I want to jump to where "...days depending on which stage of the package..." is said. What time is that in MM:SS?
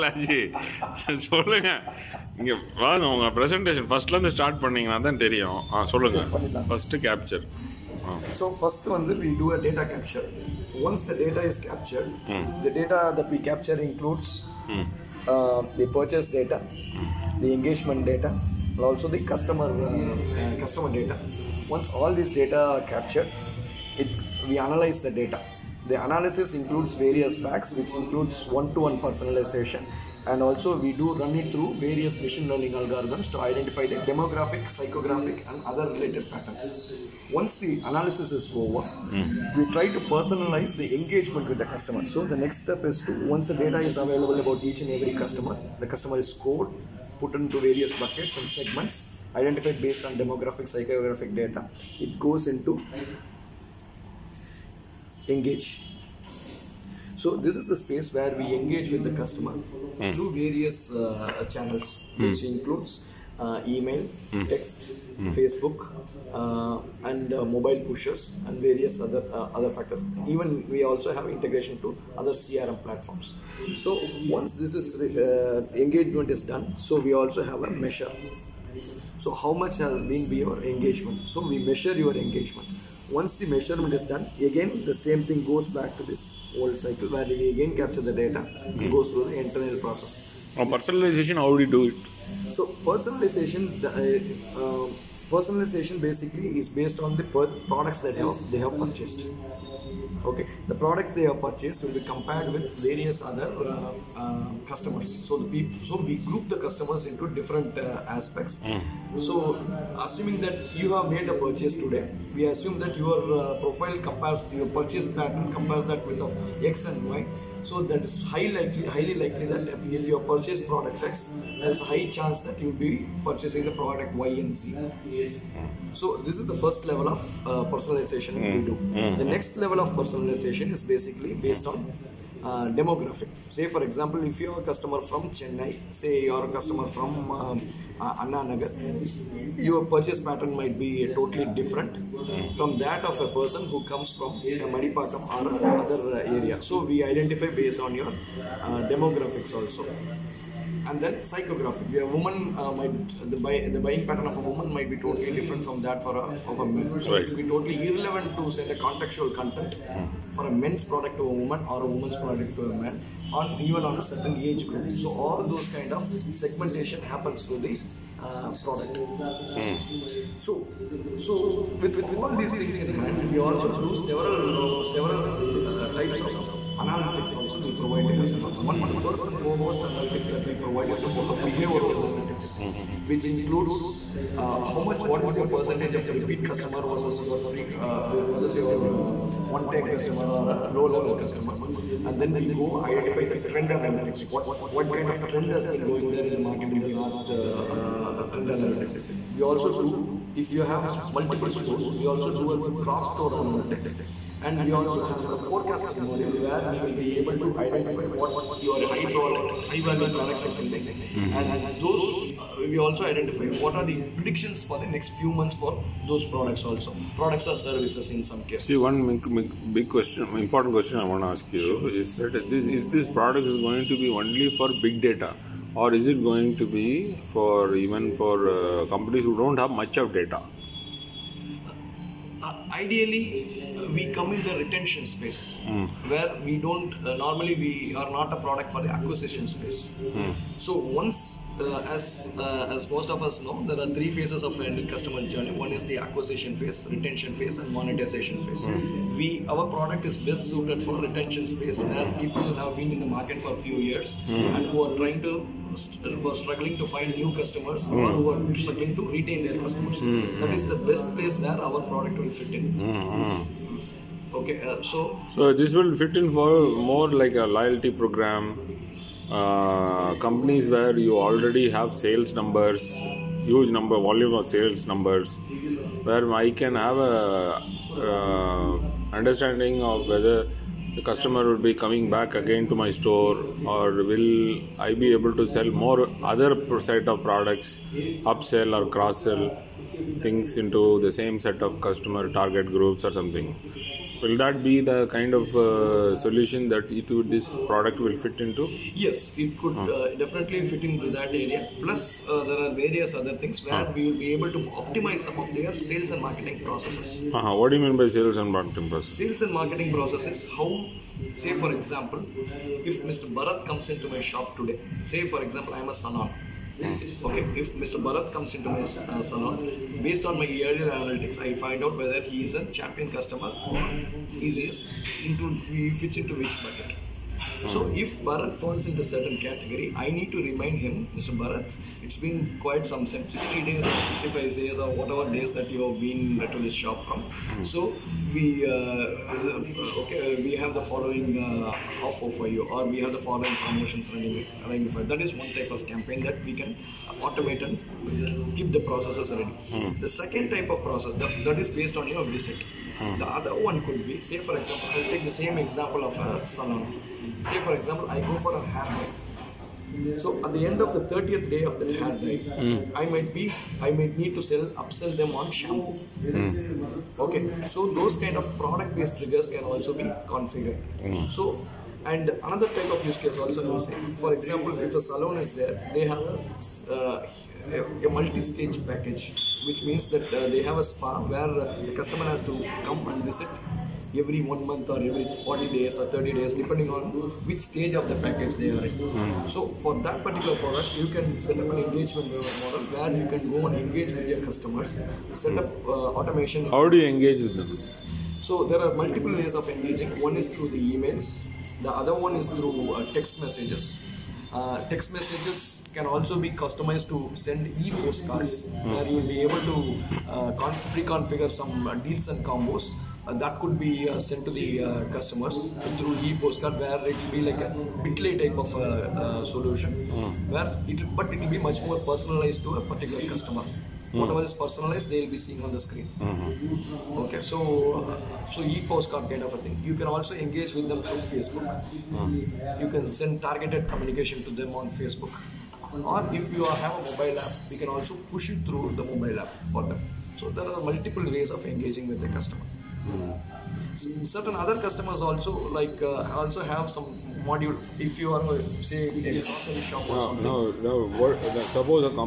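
06:26.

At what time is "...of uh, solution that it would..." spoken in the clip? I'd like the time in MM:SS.
04:55.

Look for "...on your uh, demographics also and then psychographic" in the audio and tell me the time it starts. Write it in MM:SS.
02:27.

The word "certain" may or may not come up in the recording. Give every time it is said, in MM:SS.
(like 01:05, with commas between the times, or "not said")
02:44, 05:29, 07:23.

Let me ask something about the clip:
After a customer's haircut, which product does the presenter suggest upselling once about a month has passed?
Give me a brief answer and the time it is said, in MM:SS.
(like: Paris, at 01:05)
Shampoo, at 06:05.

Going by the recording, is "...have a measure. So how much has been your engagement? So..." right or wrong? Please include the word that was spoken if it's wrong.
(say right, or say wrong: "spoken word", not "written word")
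right.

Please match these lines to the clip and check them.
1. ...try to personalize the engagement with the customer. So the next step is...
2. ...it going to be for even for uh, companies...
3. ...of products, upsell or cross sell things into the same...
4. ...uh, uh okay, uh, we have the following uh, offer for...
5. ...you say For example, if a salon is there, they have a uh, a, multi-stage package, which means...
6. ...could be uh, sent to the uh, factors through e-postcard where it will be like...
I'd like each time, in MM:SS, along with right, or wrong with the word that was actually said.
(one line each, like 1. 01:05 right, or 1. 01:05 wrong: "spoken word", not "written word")
1. 00:39 right
2. 03:46 right
3. 04:47 right
4. 05:38 right
5. 06:13 right
6. 06:53 wrong: "customers", not "factors".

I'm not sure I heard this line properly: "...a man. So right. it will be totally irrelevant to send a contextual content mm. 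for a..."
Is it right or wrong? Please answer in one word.
right.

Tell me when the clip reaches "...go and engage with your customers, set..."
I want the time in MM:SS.
06:33.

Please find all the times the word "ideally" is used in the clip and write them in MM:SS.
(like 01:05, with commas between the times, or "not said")
03:52.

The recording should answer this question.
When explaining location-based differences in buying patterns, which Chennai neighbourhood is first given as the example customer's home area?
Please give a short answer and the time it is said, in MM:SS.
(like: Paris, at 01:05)
Anna Nagar, at 02:18.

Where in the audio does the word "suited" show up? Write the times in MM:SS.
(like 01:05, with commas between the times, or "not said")
04:10.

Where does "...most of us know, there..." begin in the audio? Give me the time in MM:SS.
04:02.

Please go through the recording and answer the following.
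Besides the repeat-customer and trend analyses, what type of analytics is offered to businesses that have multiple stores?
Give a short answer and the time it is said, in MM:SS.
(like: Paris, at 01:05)
Cross-store analytics, at 03:22.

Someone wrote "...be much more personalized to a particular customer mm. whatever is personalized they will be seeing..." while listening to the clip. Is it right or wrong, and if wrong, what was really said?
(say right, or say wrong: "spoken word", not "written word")
right.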